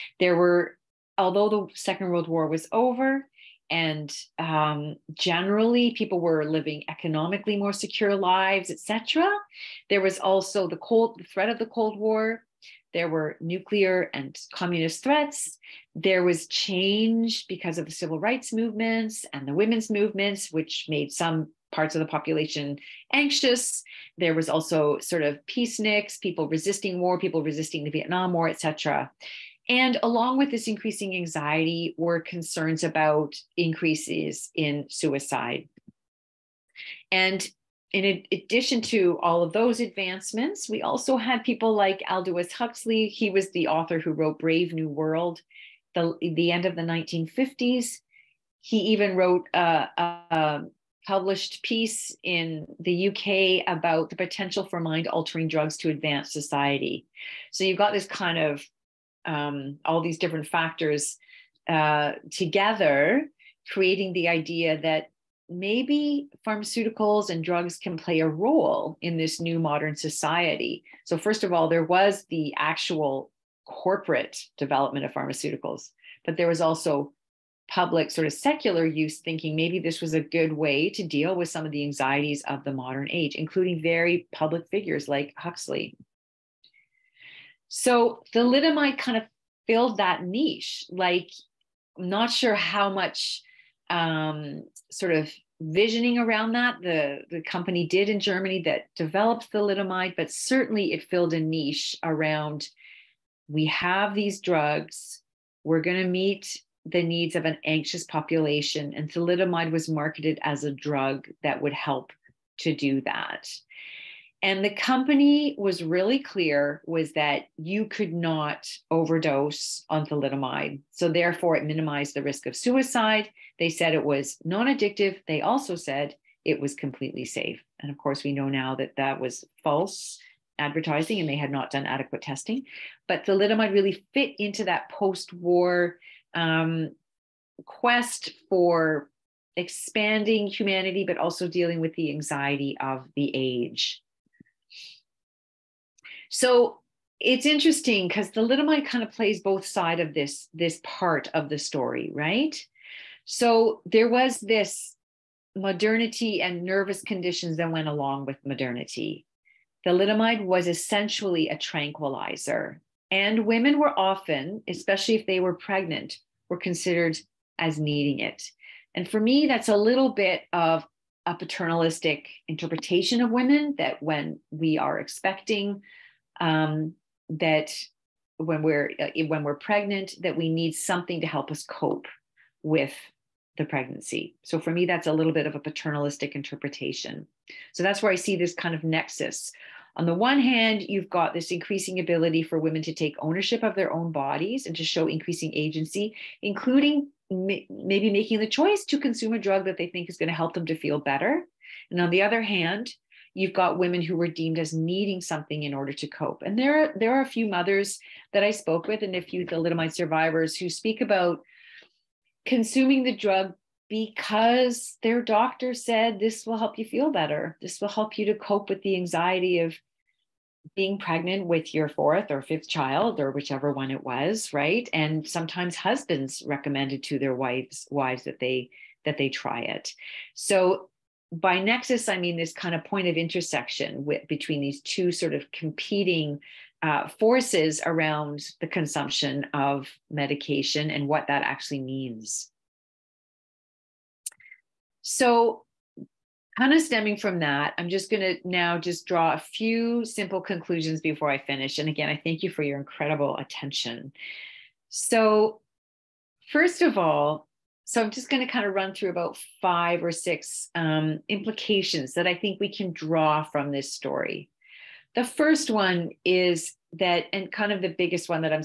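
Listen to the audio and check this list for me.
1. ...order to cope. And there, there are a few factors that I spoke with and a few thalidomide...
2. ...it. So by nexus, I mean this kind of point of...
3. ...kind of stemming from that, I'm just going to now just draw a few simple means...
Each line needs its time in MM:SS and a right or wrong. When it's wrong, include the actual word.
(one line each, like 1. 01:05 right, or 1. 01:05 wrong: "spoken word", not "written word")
1. 03:25 wrong: "mothers", not "factors"
2. 03:49 right
3. 04:06 wrong: "conclusions", not "means".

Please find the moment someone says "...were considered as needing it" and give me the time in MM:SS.
02:46.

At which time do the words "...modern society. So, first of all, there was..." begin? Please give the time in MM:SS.
01:09.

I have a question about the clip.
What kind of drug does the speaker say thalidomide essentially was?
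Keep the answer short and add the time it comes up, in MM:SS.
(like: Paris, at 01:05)
A tranquilizer, at 02:41.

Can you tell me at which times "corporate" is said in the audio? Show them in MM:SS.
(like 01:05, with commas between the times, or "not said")
01:13.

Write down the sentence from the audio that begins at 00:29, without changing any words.
And along with this increasing anxiety were concerns about increases in suicide.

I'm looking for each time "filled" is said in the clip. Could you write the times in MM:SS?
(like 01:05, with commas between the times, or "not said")
01:29, 01:41.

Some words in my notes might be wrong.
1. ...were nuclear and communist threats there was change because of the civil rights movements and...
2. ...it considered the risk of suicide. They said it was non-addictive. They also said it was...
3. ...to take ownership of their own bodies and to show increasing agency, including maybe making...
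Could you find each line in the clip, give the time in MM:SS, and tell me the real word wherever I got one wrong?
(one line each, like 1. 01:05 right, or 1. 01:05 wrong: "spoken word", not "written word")
1. 00:13 right
2. 02:01 wrong: "minimized", not "considered"
3. 03:12 right.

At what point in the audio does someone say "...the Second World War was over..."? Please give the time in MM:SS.
00:01.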